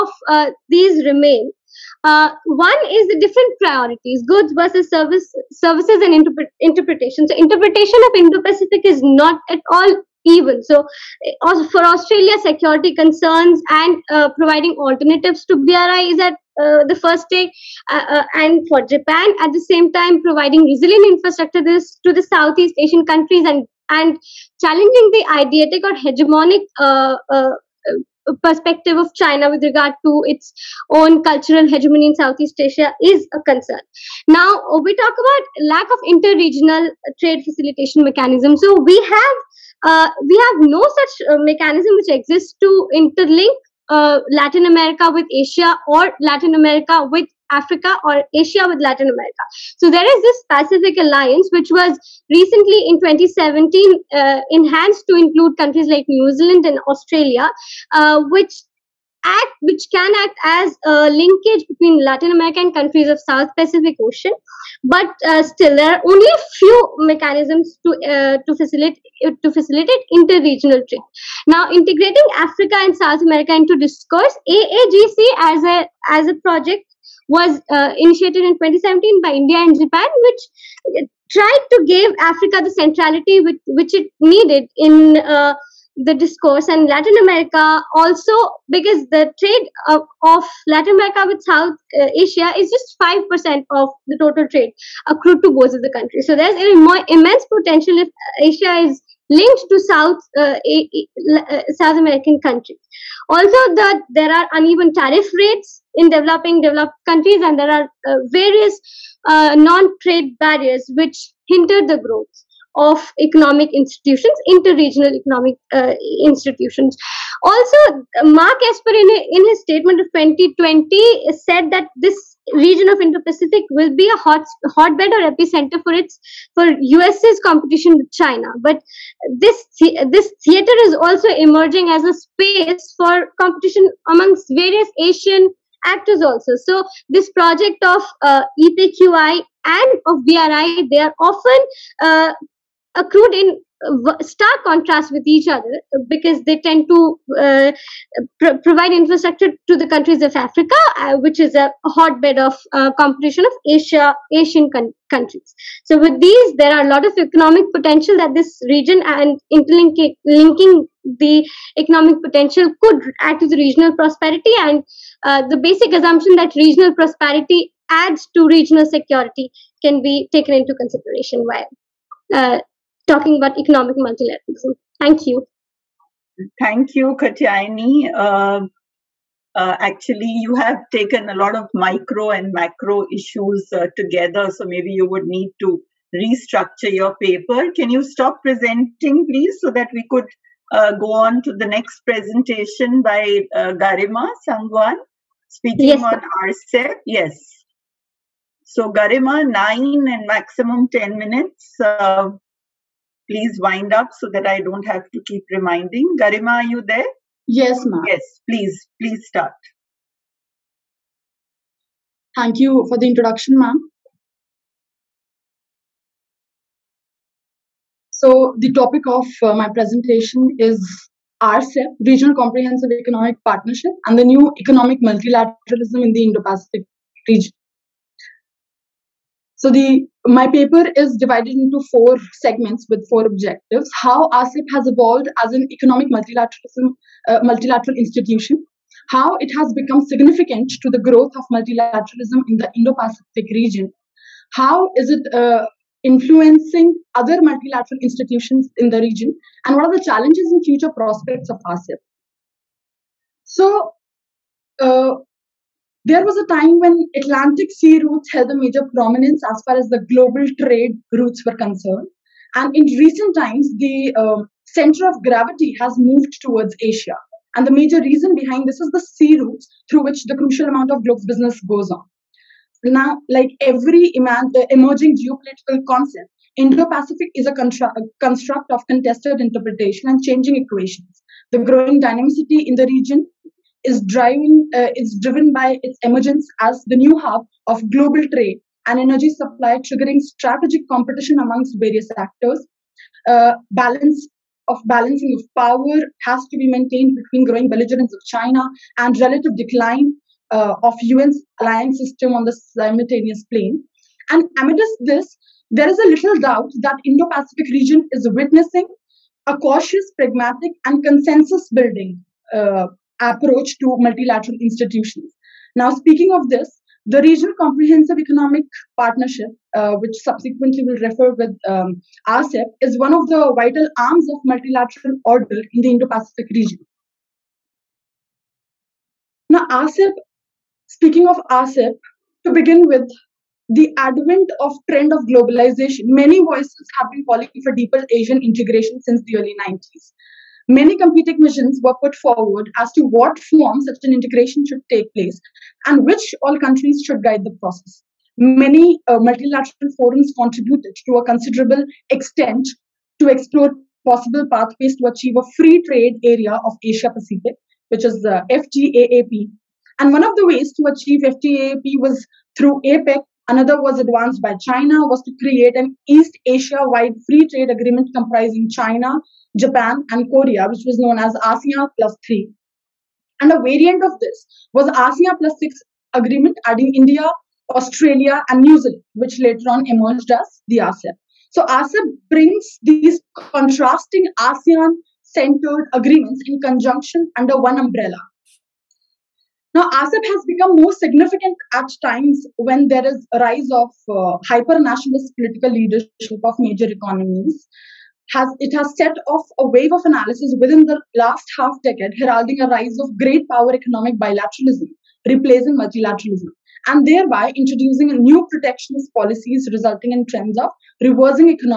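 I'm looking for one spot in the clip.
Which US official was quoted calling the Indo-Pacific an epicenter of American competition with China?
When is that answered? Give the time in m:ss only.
1:58.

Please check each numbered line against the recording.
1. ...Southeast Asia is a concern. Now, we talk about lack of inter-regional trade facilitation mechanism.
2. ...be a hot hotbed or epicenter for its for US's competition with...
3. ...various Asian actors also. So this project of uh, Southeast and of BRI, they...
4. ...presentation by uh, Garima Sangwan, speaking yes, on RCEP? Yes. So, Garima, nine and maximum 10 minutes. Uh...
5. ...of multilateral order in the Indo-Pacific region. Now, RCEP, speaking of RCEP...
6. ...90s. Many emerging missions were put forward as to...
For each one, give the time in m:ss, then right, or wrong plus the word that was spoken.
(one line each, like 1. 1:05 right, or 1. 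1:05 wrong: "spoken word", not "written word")
1. 0:32 right
2. 2:03 right
3. 2:14 wrong: "EPQI", not "Southeast"
4. 3:12 right
5. 5:24 right
6. 5:39 wrong: "competing", not "emerging".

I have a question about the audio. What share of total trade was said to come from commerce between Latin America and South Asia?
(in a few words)
5%.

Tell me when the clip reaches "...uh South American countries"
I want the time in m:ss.
1:40.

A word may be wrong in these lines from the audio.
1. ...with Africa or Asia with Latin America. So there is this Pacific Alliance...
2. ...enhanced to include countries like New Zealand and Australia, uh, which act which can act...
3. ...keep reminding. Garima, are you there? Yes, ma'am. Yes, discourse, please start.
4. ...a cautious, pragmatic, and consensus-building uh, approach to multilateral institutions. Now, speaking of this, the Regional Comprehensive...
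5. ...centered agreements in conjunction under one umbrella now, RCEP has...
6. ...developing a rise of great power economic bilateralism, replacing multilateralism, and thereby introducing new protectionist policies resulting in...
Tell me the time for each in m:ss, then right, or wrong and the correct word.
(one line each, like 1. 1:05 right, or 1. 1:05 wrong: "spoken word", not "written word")
1. 0:47 right
2. 0:54 right
3. 3:25 wrong: "please", not "discourse"
4. 5:09 right
5. 6:25 right
6. 6:42 wrong: "heralding", not "developing".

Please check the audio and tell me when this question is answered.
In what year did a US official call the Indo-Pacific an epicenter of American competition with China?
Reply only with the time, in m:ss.
2:00.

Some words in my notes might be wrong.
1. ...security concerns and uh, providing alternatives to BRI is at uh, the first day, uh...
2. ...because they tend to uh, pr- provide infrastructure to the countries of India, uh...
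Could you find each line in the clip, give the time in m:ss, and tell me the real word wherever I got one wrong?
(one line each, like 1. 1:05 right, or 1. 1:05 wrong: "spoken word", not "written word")
1. 0:12 right
2. 2:26 wrong: "Africa", not "India".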